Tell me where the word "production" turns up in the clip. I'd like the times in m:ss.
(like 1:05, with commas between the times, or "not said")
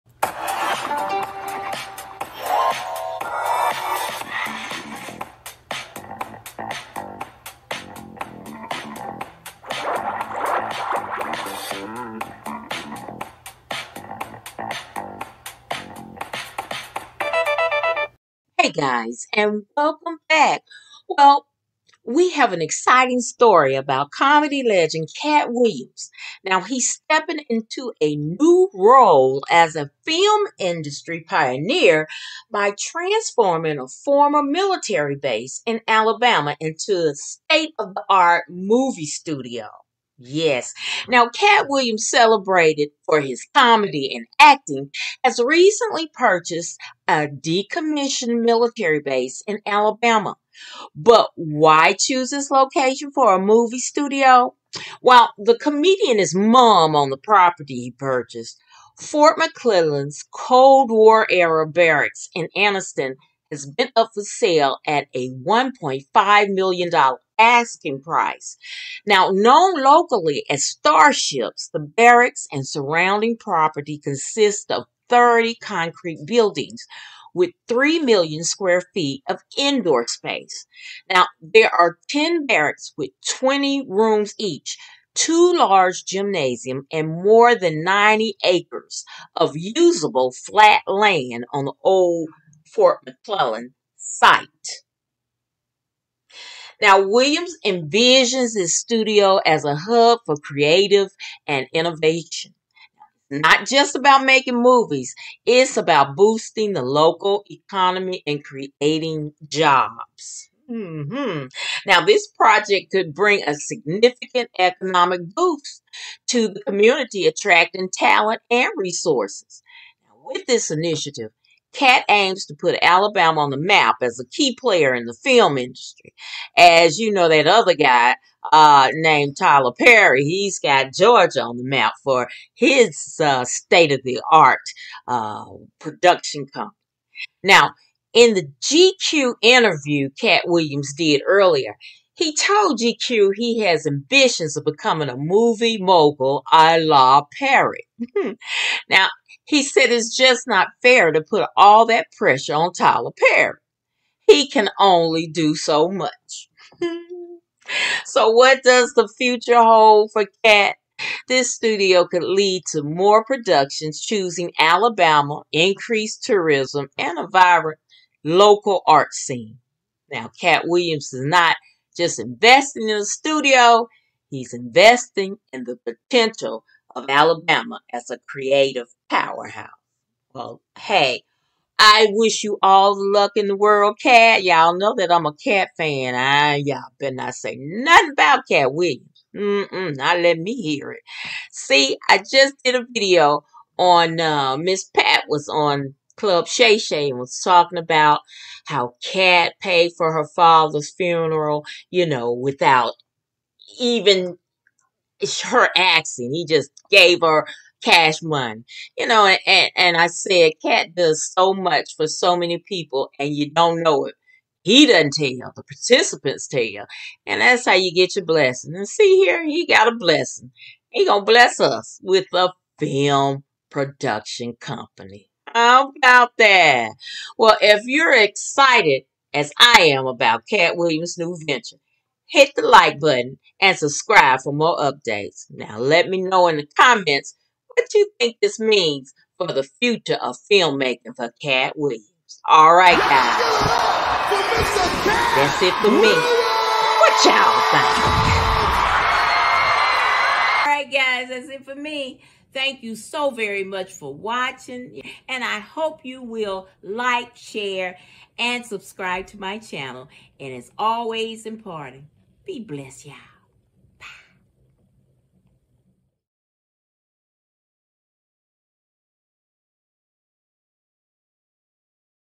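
2:15, 2:43, 3:43.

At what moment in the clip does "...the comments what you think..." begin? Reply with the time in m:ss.
3:56.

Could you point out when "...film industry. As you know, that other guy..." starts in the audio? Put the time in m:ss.
2:05.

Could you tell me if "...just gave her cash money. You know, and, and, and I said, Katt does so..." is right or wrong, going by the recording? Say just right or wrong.
right.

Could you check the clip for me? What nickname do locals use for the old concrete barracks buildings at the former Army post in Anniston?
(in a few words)
starships.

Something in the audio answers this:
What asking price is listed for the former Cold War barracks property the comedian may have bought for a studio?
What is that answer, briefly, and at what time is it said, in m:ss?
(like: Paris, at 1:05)
$1.5 million, at 1:05.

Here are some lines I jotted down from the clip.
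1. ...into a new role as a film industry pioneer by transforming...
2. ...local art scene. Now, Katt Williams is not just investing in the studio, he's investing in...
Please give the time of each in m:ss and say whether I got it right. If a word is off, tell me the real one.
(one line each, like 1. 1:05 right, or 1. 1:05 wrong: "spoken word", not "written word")
1. 0:27 right
2. 2:48 right.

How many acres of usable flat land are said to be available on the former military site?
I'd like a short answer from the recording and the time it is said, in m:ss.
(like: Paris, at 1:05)
90, at 1:27.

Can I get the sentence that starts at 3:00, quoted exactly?
Well, hey, I wish you all the luck in the world, Katt.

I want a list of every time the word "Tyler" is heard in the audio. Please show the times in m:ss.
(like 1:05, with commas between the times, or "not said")
2:09, 2:32.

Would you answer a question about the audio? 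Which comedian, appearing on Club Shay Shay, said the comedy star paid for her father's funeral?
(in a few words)
Miss Pat.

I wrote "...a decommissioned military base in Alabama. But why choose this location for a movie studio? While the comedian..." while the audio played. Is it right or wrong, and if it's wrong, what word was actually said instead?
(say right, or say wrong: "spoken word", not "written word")
right.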